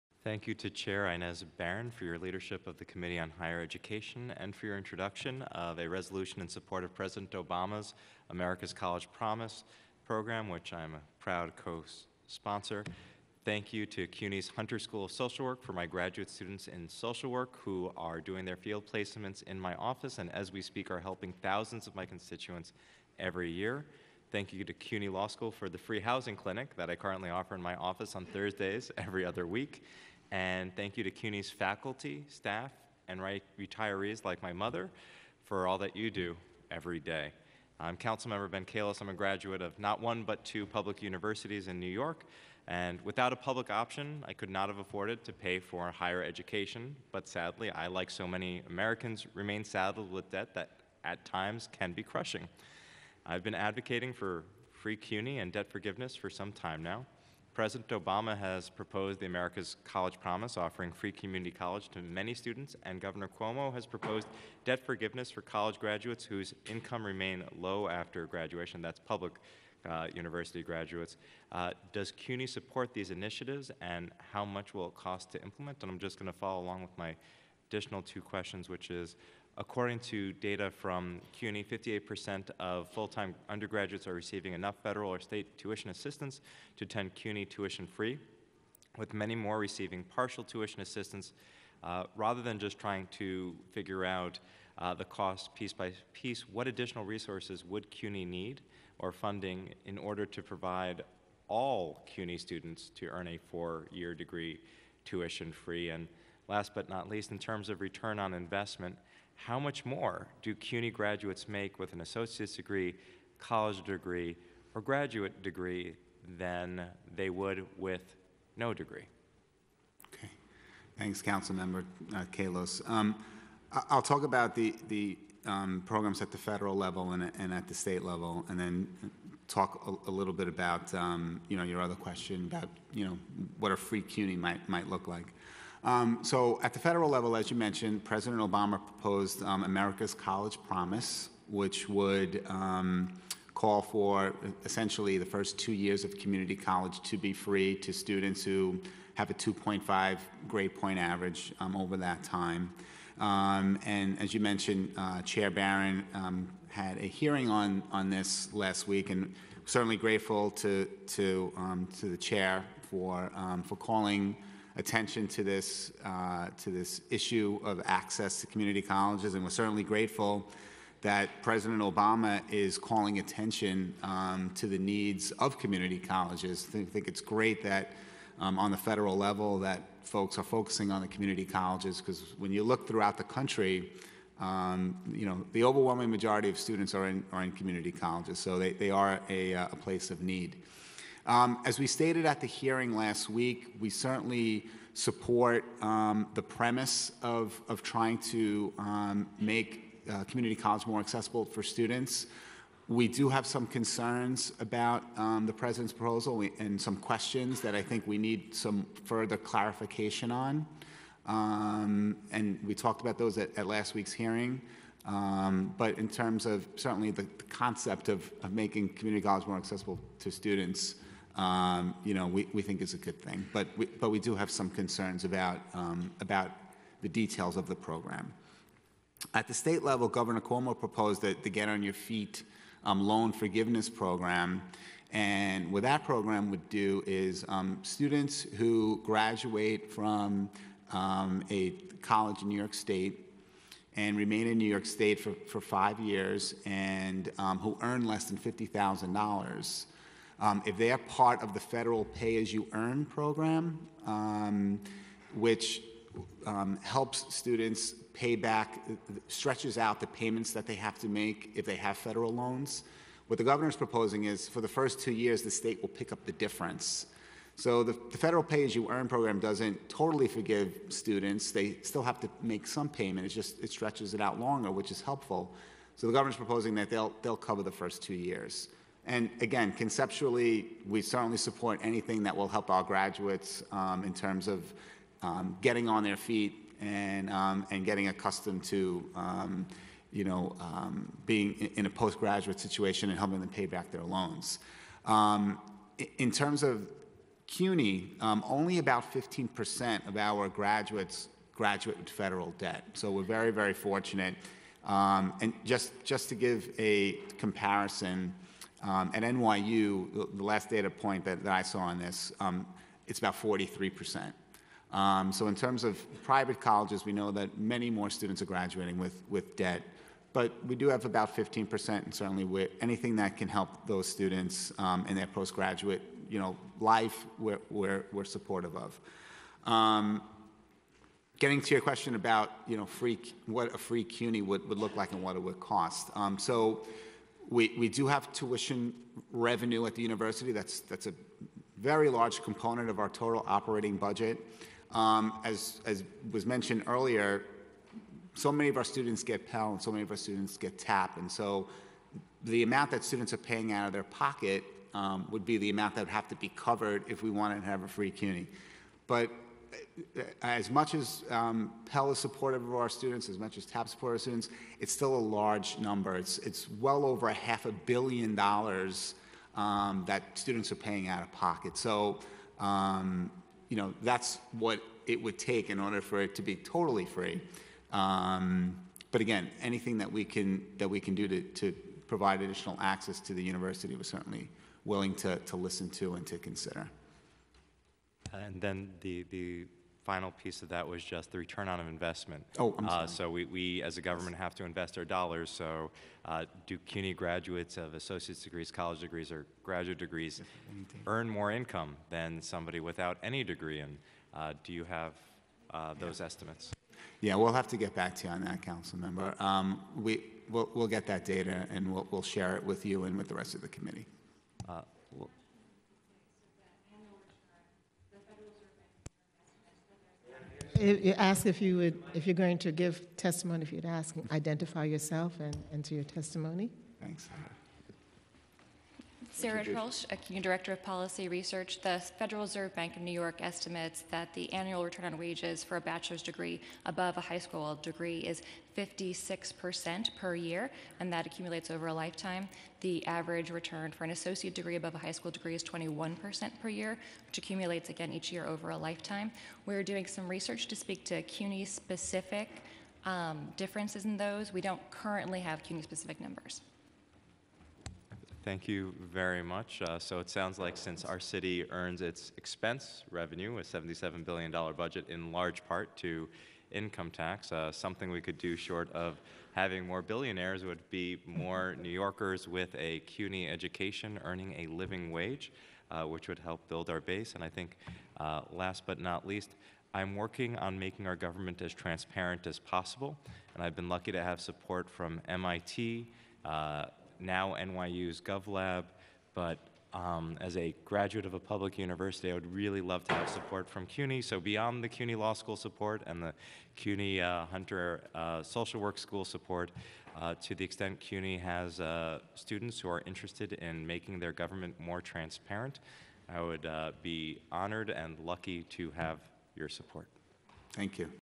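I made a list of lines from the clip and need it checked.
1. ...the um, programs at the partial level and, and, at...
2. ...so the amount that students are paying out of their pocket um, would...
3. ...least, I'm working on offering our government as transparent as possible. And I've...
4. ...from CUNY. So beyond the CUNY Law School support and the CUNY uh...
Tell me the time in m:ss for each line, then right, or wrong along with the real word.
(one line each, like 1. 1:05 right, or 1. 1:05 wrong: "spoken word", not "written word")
1. 2:04 wrong: "federal", not "partial"
2. 5:51 right
3. 7:59 wrong: "making", not "offering"
4. 8:13 right.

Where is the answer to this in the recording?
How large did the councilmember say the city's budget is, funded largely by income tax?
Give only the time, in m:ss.
7:43.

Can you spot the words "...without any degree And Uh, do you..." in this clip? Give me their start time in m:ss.
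6:42.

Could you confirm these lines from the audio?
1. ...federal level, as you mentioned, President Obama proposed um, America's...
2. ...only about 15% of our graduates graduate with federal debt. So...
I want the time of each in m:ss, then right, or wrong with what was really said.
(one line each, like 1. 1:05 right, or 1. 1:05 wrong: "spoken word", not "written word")
1. 2:16 right
2. 4:58 right.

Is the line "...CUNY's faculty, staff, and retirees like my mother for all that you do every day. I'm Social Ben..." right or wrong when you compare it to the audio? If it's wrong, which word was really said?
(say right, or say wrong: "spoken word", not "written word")
wrong: "Councilmember", not "Social".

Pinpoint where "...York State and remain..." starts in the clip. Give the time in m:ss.
4:02.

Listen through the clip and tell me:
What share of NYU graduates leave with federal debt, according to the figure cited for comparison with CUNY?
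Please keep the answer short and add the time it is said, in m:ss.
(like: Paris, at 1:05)
43%, at 5:13.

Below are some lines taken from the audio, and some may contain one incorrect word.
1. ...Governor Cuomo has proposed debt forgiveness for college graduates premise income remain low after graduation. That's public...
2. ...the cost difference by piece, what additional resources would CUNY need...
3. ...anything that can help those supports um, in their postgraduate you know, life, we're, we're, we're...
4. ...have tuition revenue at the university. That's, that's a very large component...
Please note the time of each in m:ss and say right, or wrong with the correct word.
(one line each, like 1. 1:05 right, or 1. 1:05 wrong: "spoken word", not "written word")
1. 1:03 wrong: "whose", not "premise"
2. 1:34 wrong: "piece", not "difference"
3. 5:22 wrong: "students", not "supports"
4. 5:38 right.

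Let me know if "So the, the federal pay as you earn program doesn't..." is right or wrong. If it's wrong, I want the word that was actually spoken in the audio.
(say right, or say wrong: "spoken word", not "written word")
right.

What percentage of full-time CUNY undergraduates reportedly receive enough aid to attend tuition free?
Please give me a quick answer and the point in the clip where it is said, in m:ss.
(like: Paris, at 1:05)
58%, at 1:21.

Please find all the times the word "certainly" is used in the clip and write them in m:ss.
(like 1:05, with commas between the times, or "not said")
2:39, 2:49, 3:13, 3:36, 4:41, 5:22, 6:24.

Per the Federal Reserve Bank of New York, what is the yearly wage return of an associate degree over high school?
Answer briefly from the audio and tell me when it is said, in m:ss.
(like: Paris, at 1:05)
21%, at 7:25.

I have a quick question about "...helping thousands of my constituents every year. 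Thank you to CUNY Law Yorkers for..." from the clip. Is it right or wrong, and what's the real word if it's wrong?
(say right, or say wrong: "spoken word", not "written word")
wrong: "School", not "Yorkers".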